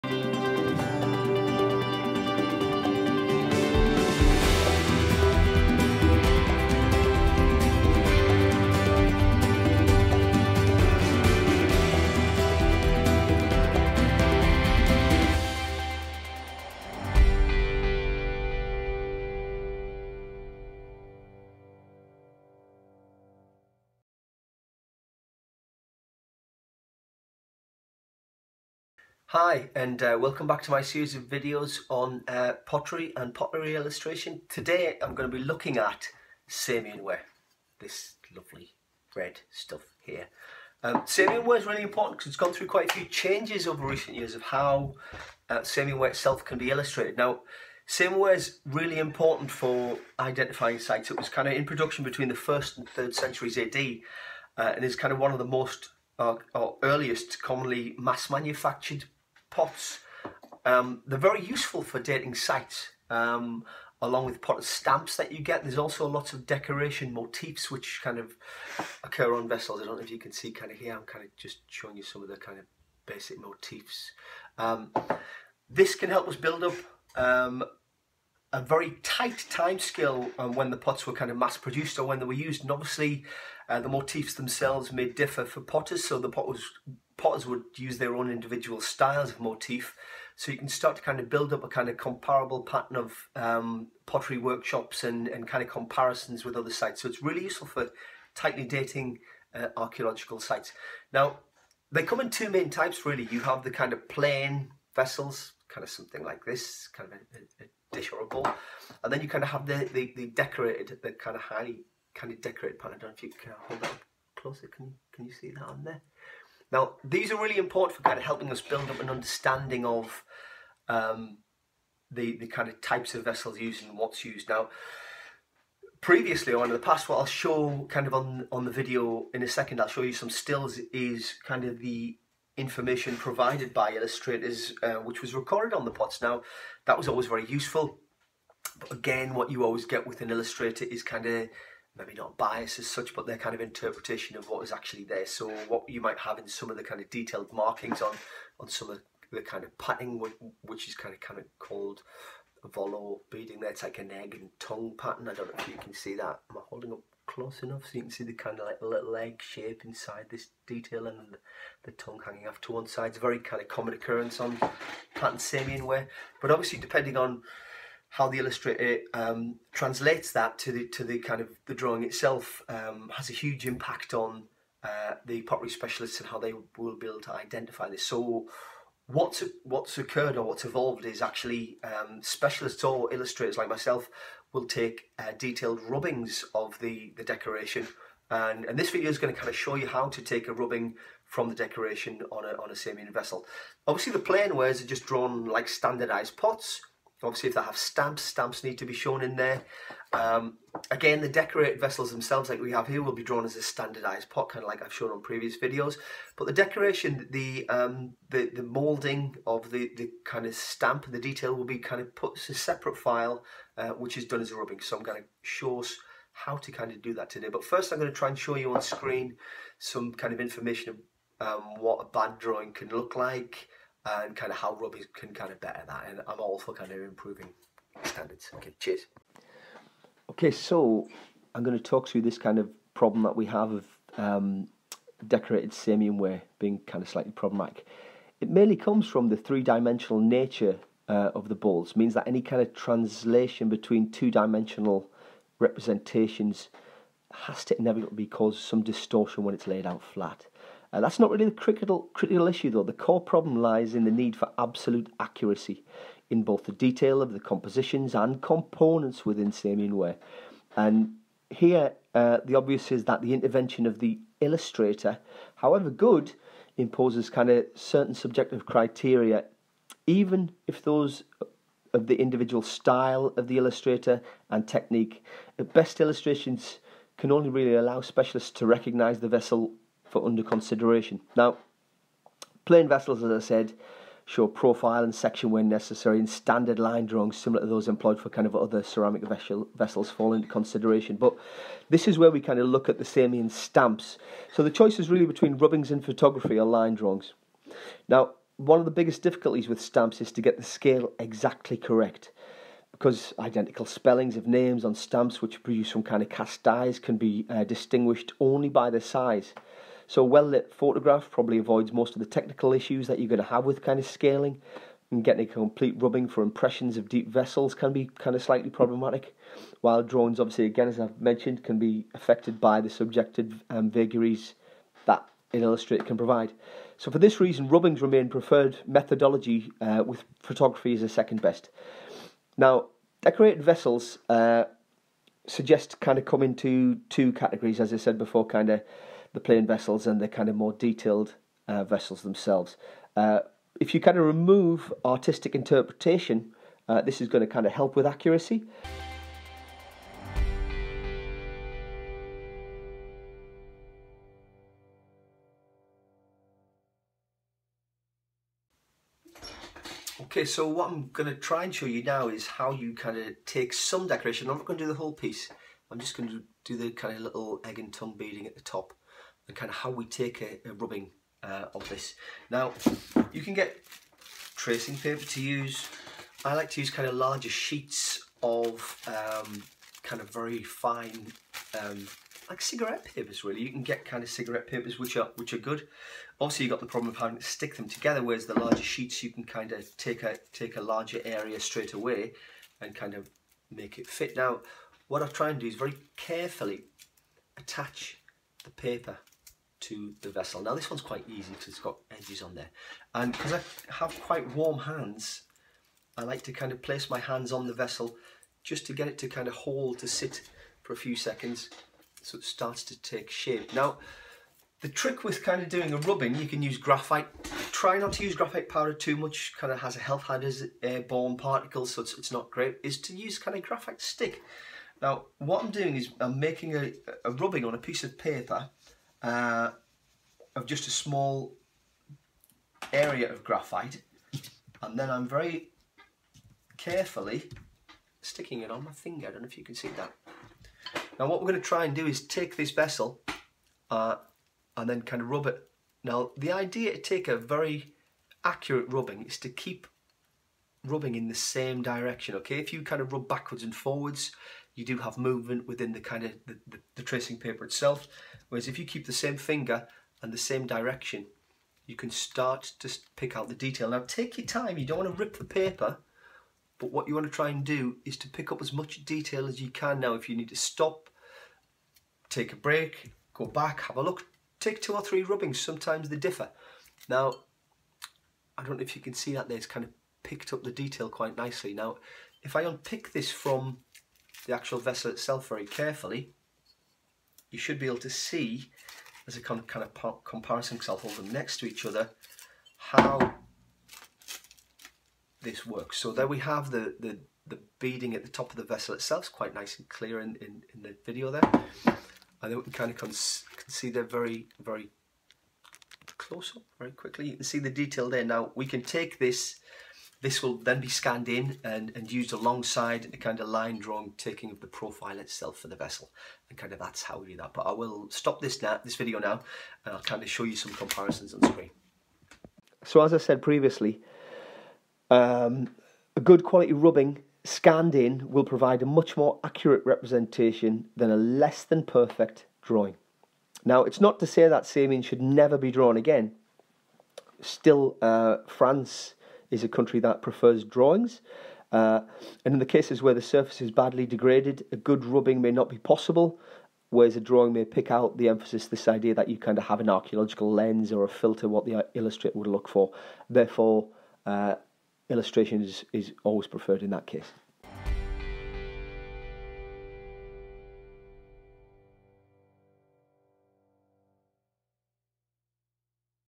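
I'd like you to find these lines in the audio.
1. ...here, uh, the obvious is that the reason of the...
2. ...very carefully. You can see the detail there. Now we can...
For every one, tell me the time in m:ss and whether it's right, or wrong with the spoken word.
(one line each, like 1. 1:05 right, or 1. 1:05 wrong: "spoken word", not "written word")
1. 4:21 wrong: "intervention", not "reason"
2. 8:26 wrong: "quickly", not "carefully".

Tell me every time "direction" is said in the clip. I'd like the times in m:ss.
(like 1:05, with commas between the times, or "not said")
7:31, 7:40.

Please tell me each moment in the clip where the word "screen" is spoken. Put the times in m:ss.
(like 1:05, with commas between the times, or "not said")
3:38, 8:41.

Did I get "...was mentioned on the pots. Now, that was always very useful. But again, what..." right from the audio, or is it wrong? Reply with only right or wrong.
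wrong.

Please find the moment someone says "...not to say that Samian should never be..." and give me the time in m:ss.
8:54.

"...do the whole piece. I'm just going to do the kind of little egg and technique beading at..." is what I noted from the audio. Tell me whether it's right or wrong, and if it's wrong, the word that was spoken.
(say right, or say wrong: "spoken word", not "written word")
wrong: "tongue", not "technique".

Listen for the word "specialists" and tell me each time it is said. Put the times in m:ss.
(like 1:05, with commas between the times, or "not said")
2:55, 3:02, 4:38.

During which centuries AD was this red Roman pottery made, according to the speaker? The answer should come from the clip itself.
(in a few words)
1st and 3rd centuries AD.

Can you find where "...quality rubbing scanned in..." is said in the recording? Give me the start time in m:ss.
8:46.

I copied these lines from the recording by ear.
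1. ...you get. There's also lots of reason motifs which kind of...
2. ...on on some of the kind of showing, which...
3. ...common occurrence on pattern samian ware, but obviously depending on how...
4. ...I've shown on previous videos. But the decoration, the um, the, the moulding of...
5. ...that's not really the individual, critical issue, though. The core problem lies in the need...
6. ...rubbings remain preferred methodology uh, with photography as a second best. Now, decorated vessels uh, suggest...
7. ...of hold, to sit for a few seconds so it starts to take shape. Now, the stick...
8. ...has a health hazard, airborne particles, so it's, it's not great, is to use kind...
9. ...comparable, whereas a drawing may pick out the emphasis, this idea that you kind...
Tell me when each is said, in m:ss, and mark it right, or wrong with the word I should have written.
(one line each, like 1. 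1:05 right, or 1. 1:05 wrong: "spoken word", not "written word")
1. 1:05 wrong: "decoration", not "reason"
2. 2:28 wrong: "patting", not "showing"
3. 2:43 right
4. 3:24 right
5. 4:10 wrong: "critical", not "individual"
6. 5:27 right
7. 6:49 wrong: "trick", not "stick"
8. 6:59 right
9. 9:05 wrong: "possible", not "comparable".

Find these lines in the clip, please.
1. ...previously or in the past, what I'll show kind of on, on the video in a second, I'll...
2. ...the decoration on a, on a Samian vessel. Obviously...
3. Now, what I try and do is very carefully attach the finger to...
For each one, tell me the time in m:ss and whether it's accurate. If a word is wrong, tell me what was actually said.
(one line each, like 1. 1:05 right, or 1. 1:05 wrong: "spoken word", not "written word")
1. 2:05 right
2. 3:11 right
3. 6:34 wrong: "paper", not "finger".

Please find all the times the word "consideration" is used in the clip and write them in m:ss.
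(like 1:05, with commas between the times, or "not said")
4:40, 4:50.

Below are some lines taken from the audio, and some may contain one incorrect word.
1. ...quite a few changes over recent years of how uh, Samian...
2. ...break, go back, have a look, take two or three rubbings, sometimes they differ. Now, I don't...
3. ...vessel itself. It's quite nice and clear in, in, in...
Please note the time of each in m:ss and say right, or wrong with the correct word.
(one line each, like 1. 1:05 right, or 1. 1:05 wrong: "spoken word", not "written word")
1. 0:42 right
2. 7:52 right
3. 8:18 right.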